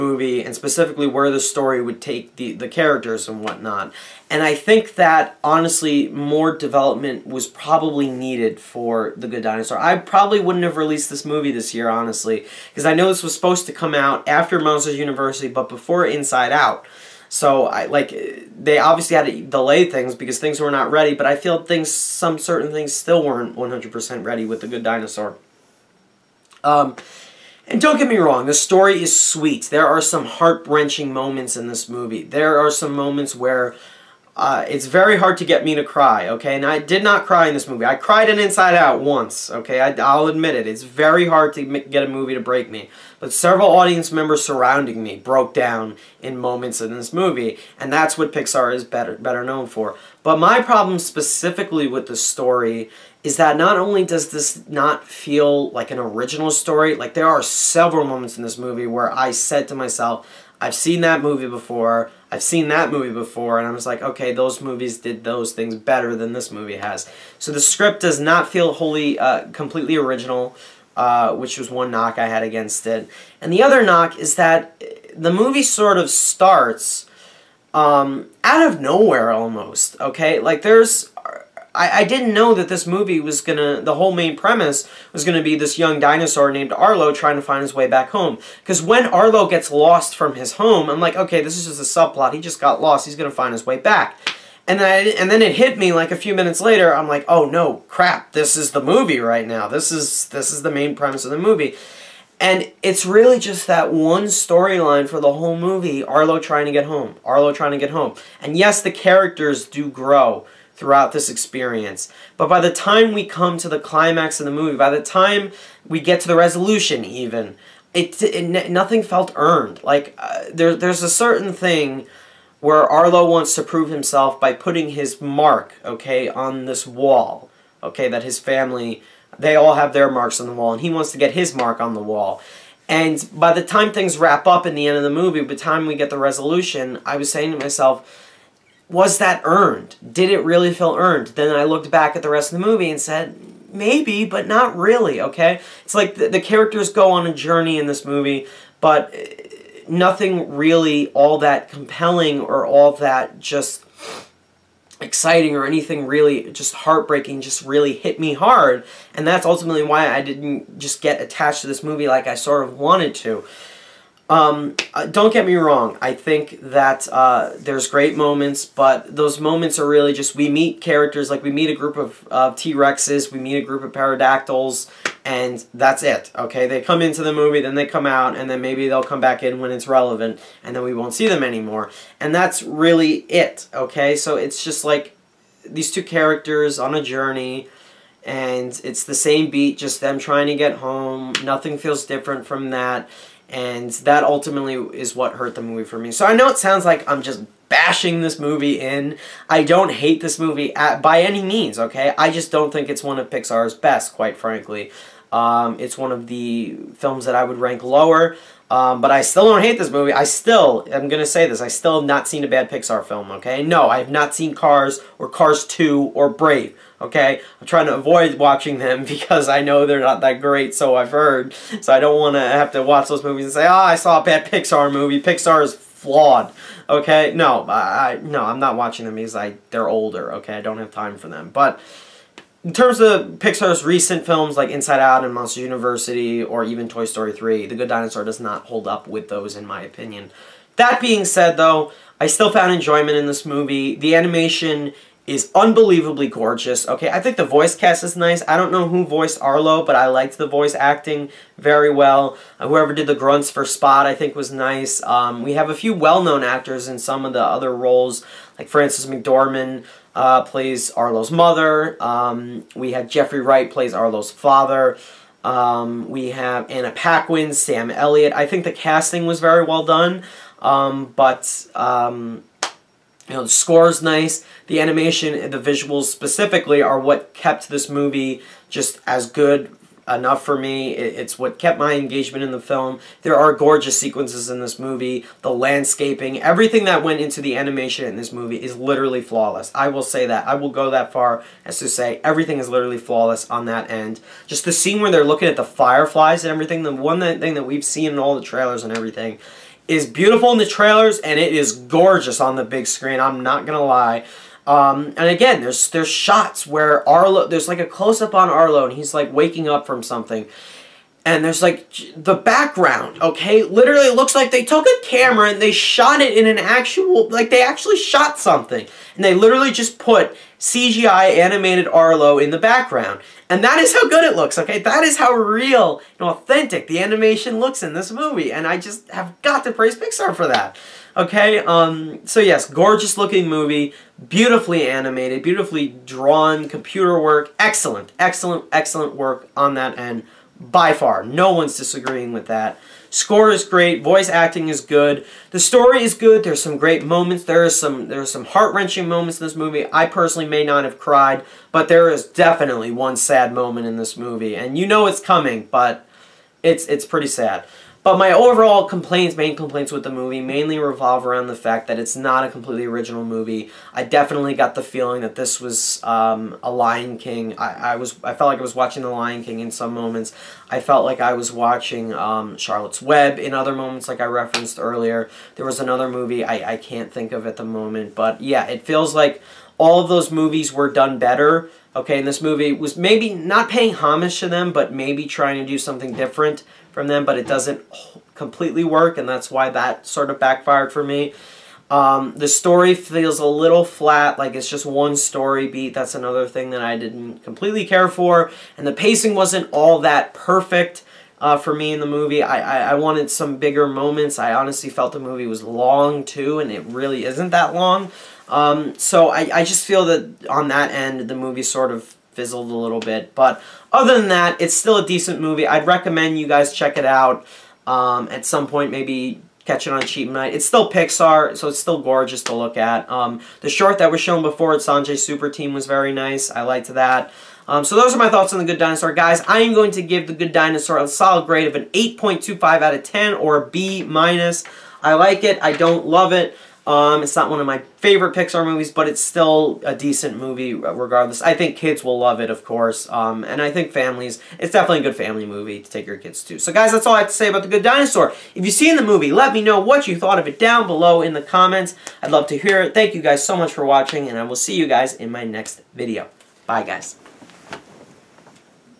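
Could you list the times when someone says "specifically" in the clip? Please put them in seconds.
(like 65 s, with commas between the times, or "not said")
0 s, 50 s, 276 s.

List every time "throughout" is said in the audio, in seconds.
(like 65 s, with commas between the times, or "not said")
110 s.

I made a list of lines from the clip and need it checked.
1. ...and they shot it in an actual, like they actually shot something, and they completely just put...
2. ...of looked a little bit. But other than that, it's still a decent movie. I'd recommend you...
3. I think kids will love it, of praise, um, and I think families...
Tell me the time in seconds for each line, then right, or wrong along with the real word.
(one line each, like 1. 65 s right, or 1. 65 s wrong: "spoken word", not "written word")
1. 315 s wrong: "literally", not "completely"
2. 411 s wrong: "fizzled", not "looked"
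3. 441 s wrong: "course", not "praise".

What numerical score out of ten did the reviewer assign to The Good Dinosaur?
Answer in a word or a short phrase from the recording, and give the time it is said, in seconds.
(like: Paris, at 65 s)
8.25, at 431 s.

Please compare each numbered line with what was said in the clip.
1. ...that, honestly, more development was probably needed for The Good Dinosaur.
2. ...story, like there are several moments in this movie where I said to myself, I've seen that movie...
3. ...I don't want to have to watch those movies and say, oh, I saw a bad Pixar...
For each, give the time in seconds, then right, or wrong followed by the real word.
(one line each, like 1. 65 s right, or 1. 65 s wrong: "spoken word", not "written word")
1. 4 s right
2. 56 s right
3. 221 s right.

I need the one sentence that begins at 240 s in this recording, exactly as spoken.
That being said though, I still found enjoyment in this movie.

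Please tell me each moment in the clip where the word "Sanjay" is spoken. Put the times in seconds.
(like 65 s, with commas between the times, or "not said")
424 s.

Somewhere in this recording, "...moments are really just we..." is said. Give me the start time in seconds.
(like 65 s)
169 s.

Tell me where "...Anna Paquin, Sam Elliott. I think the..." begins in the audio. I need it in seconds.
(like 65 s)
266 s.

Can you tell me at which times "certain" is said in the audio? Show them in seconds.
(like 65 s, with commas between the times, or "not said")
22 s, 121 s.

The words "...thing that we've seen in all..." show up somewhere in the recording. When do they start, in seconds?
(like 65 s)
297 s.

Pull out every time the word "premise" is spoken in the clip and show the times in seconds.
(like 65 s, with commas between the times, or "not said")
84 s, 100 s.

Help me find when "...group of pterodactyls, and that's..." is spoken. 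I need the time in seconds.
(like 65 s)
173 s.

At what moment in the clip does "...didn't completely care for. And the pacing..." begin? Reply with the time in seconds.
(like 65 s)
396 s.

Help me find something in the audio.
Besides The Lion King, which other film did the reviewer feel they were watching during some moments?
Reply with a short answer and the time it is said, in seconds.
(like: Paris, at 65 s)
Charlotte's Web, at 372 s.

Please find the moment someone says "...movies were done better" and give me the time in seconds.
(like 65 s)
380 s.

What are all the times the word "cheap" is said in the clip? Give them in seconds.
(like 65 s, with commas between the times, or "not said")
420 s.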